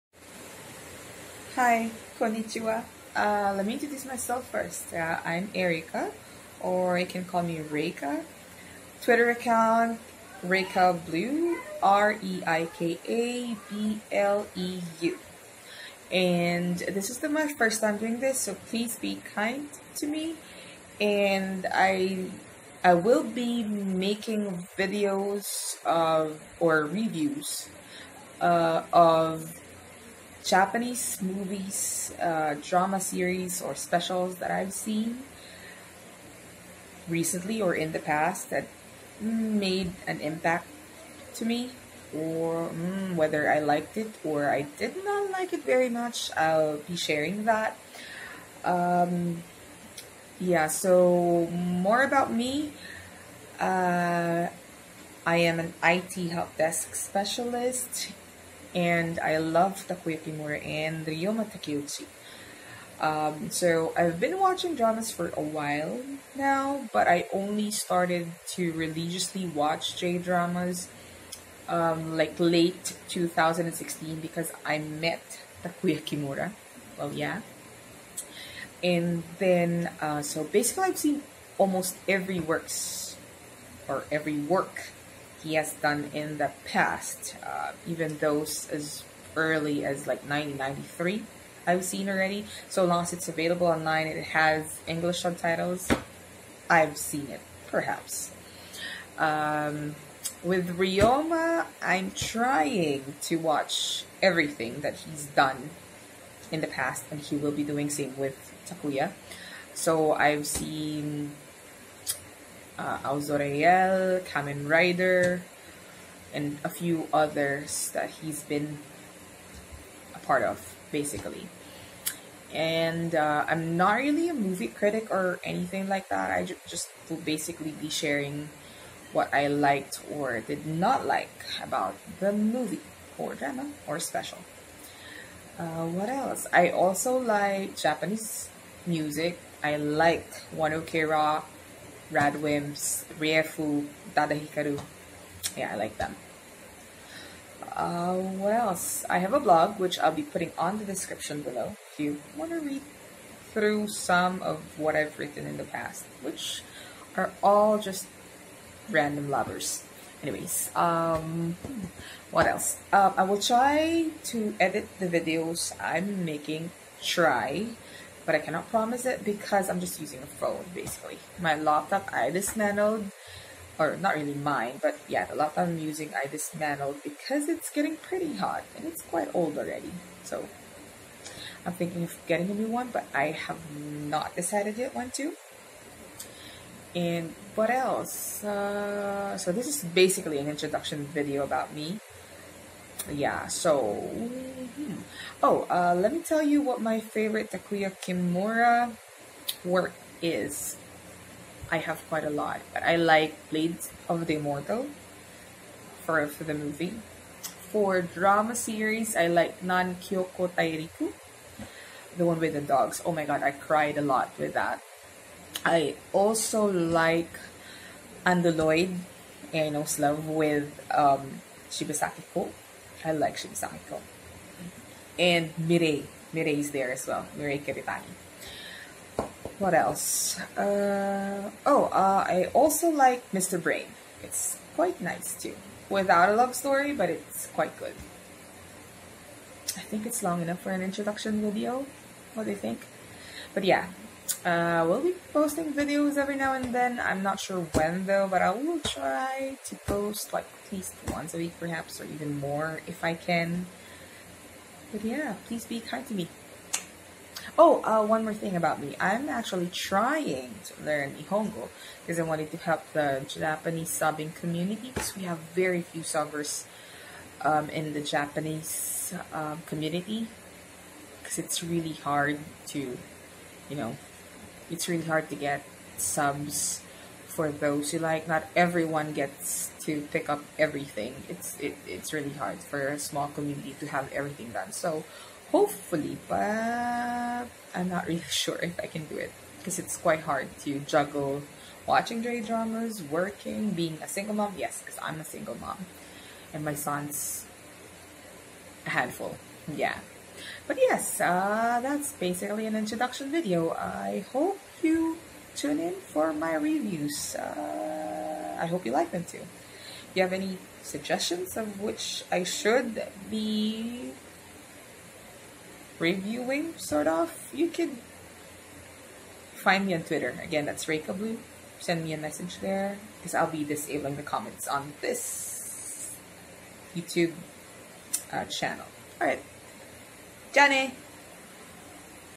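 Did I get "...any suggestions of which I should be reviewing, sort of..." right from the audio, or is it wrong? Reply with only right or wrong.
right.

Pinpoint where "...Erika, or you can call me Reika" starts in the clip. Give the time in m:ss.
0:05.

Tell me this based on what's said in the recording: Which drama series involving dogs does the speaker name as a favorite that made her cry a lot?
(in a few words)
Nankyoku Tairiku.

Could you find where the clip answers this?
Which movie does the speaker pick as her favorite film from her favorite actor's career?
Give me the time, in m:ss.
3:23.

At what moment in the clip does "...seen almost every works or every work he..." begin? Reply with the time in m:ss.
1:20.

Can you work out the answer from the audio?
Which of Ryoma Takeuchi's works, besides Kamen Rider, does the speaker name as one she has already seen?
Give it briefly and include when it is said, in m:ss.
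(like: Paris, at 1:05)
Aozora Yell, at 1:52.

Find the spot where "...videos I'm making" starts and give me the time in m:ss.
2:45.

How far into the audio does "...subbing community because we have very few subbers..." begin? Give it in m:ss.
4:23.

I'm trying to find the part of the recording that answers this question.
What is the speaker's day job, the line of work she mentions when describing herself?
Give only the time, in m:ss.
0:55.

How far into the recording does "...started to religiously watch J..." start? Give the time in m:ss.
1:07.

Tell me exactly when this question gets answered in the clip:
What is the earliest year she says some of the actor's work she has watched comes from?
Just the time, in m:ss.
1:30.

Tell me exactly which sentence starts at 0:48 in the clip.
Um, yeah, so more about me.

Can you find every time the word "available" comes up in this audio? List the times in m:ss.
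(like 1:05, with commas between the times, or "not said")
1:33.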